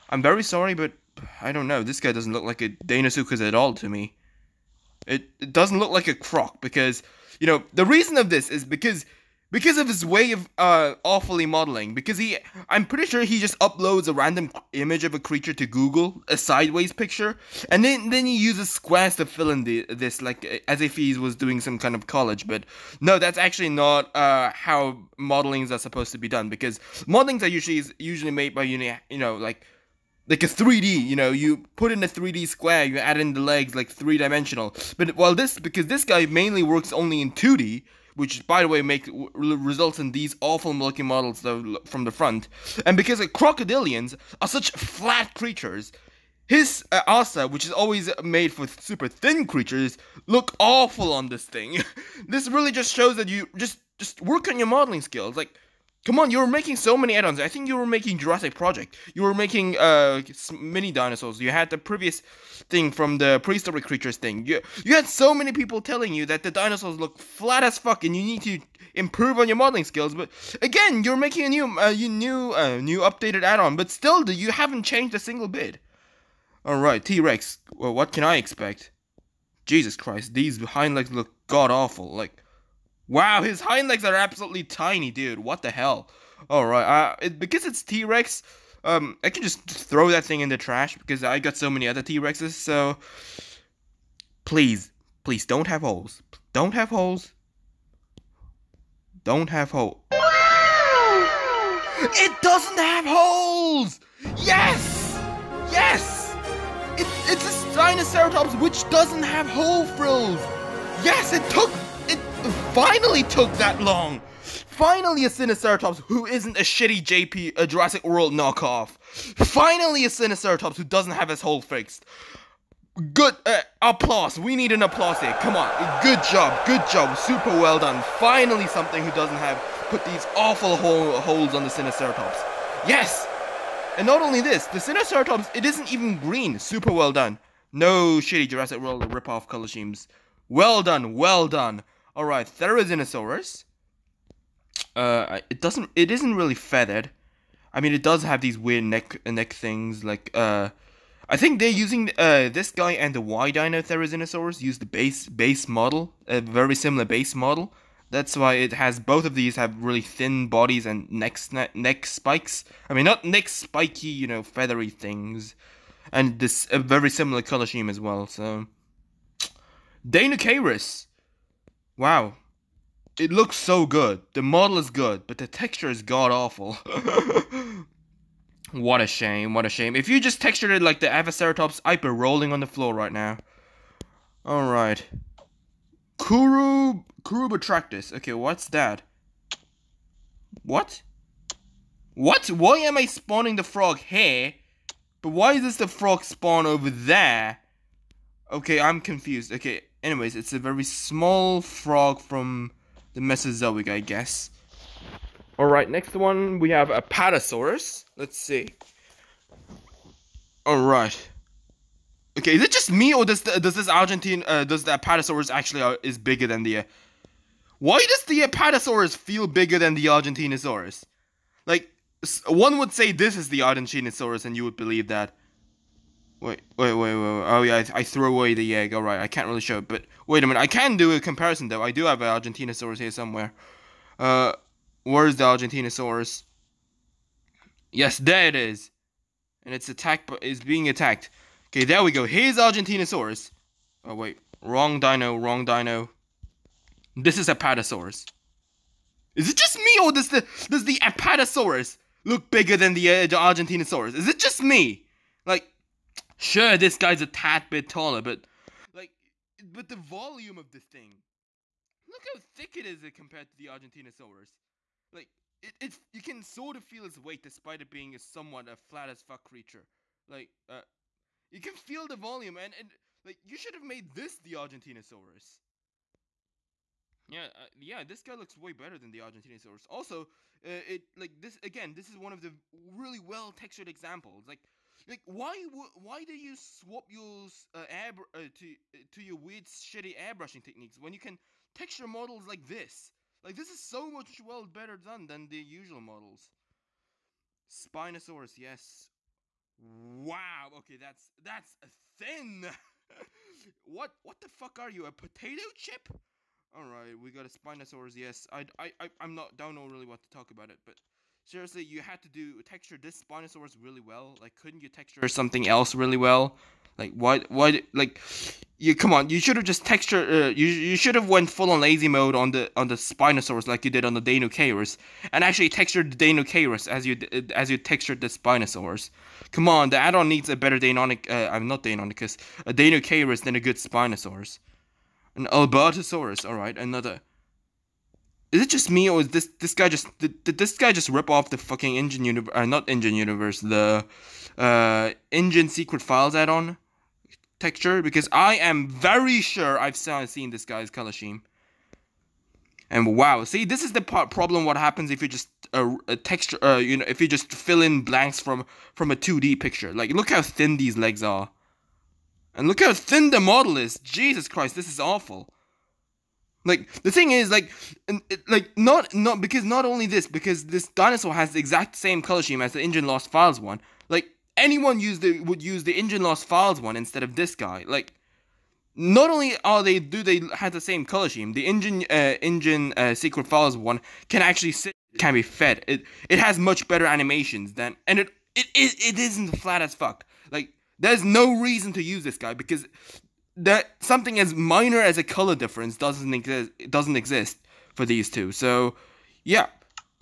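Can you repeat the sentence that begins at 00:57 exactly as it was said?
I think you were making Jurassic Project.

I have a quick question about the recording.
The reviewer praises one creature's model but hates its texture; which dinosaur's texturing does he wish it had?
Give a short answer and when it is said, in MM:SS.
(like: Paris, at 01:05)
Avaceratops, at 03:01.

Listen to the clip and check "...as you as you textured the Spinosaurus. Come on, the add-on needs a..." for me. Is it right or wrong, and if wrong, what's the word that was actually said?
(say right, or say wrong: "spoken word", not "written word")
right.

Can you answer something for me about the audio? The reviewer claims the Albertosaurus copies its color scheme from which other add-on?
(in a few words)
InGen Secret Files.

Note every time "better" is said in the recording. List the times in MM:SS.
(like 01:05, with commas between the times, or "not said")
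04:38, 04:54, 05:30, 06:26.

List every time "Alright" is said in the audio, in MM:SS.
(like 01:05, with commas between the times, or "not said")
03:04, 03:25, 03:30.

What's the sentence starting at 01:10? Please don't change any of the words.
But again, you're making a new uh, you new uh, new updated add-on, but still, you haven't changed a single bit.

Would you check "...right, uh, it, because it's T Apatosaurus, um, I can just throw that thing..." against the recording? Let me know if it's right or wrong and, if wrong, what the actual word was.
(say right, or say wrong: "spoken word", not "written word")
wrong: "Rex", not "Apatosaurus".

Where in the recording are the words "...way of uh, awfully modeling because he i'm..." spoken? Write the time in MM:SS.
00:10.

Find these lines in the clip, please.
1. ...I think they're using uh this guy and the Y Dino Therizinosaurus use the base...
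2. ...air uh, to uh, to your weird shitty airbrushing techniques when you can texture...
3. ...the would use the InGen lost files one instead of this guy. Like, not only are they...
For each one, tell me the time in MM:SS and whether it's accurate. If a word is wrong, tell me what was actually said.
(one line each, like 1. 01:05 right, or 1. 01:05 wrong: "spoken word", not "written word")
1. 02:31 right
2. 04:47 right
3. 06:15 right.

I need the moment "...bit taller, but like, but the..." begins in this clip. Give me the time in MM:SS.
04:17.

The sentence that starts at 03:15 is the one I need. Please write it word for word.
But why is this the frog spawn over there?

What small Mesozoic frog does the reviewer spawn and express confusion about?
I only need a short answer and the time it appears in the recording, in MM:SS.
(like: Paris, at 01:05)
Kurubatractus, at 03:07.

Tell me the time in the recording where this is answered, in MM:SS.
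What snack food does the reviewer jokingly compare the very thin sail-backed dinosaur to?
05:05.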